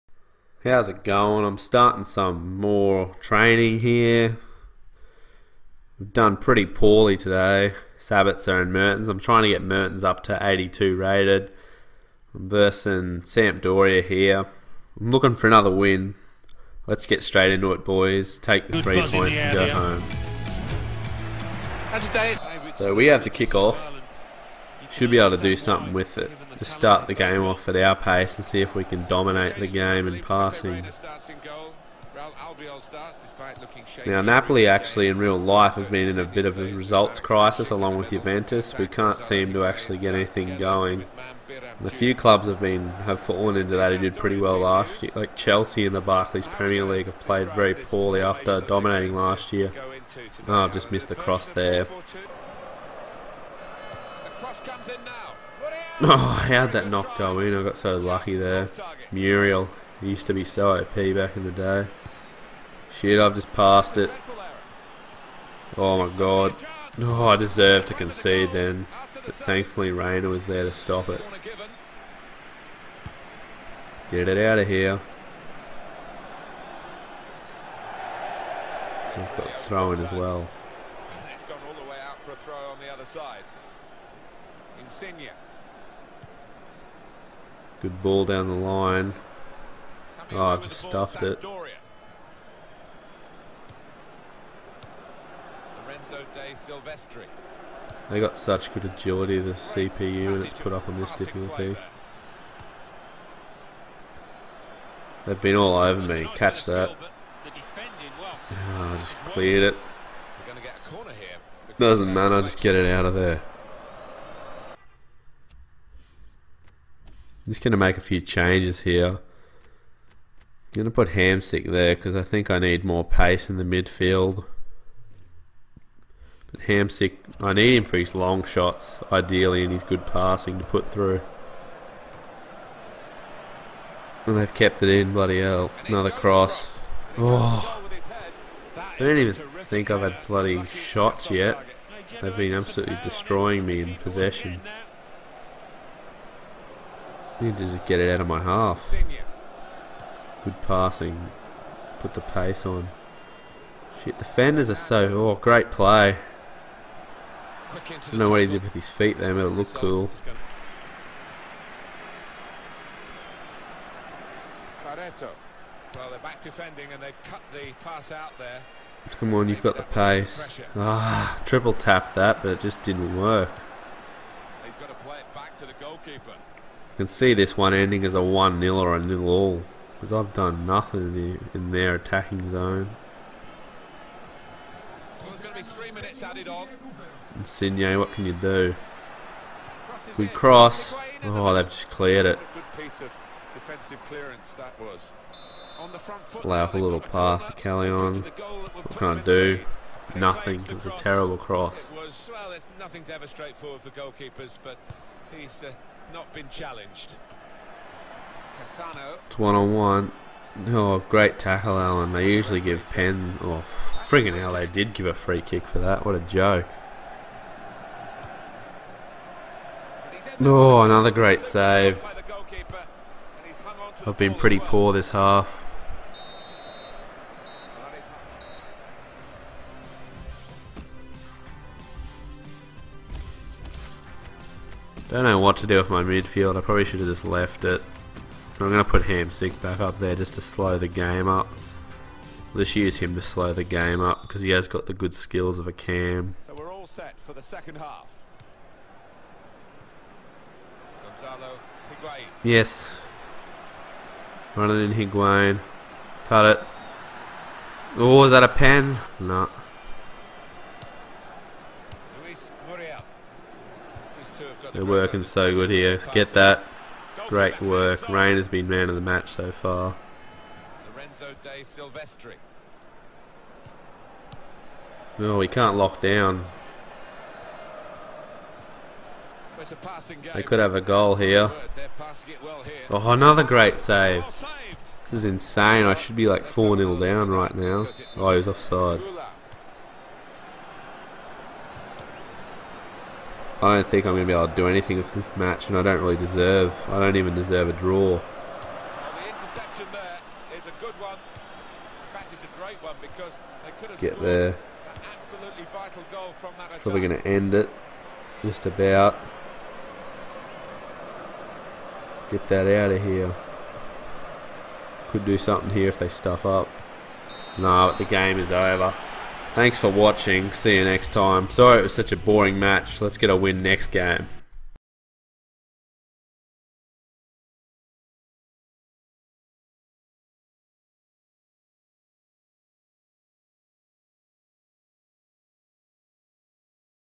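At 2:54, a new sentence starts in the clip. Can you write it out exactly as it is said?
He's got to play it back to the goalkeeper can see this one ending as a 1-0 or a nil all.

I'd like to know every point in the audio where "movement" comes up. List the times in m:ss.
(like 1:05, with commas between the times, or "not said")
not said.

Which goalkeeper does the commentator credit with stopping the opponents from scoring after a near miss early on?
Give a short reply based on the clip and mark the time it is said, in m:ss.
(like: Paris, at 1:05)
Reina, at 1:09.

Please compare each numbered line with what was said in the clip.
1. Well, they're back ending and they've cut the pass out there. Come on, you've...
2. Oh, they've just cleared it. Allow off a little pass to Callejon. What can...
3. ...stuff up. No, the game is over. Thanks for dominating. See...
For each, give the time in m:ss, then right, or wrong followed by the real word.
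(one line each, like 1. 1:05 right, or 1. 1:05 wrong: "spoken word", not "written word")
1. 2:45 wrong: "defending", not "ending"
2. 3:11 right
3. 5:16 wrong: "watching", not "dominating".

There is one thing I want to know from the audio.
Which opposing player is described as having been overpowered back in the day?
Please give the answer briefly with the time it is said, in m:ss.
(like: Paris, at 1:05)
Muriel, at 0:59.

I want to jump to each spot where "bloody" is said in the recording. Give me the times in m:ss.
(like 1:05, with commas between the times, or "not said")
2:15, 2:20.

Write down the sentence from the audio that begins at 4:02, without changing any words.
Let's use him to slow the game up because he has got the good skills of a cam.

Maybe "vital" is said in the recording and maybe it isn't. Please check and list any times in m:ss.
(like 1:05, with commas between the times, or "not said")
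5:05.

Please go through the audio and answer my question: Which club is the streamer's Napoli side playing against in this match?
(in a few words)
Sampdoria.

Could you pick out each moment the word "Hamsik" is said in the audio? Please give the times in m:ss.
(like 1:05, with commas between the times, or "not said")
2:01, 2:06, 3:59.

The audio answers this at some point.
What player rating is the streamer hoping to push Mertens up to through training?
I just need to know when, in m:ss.
0:10.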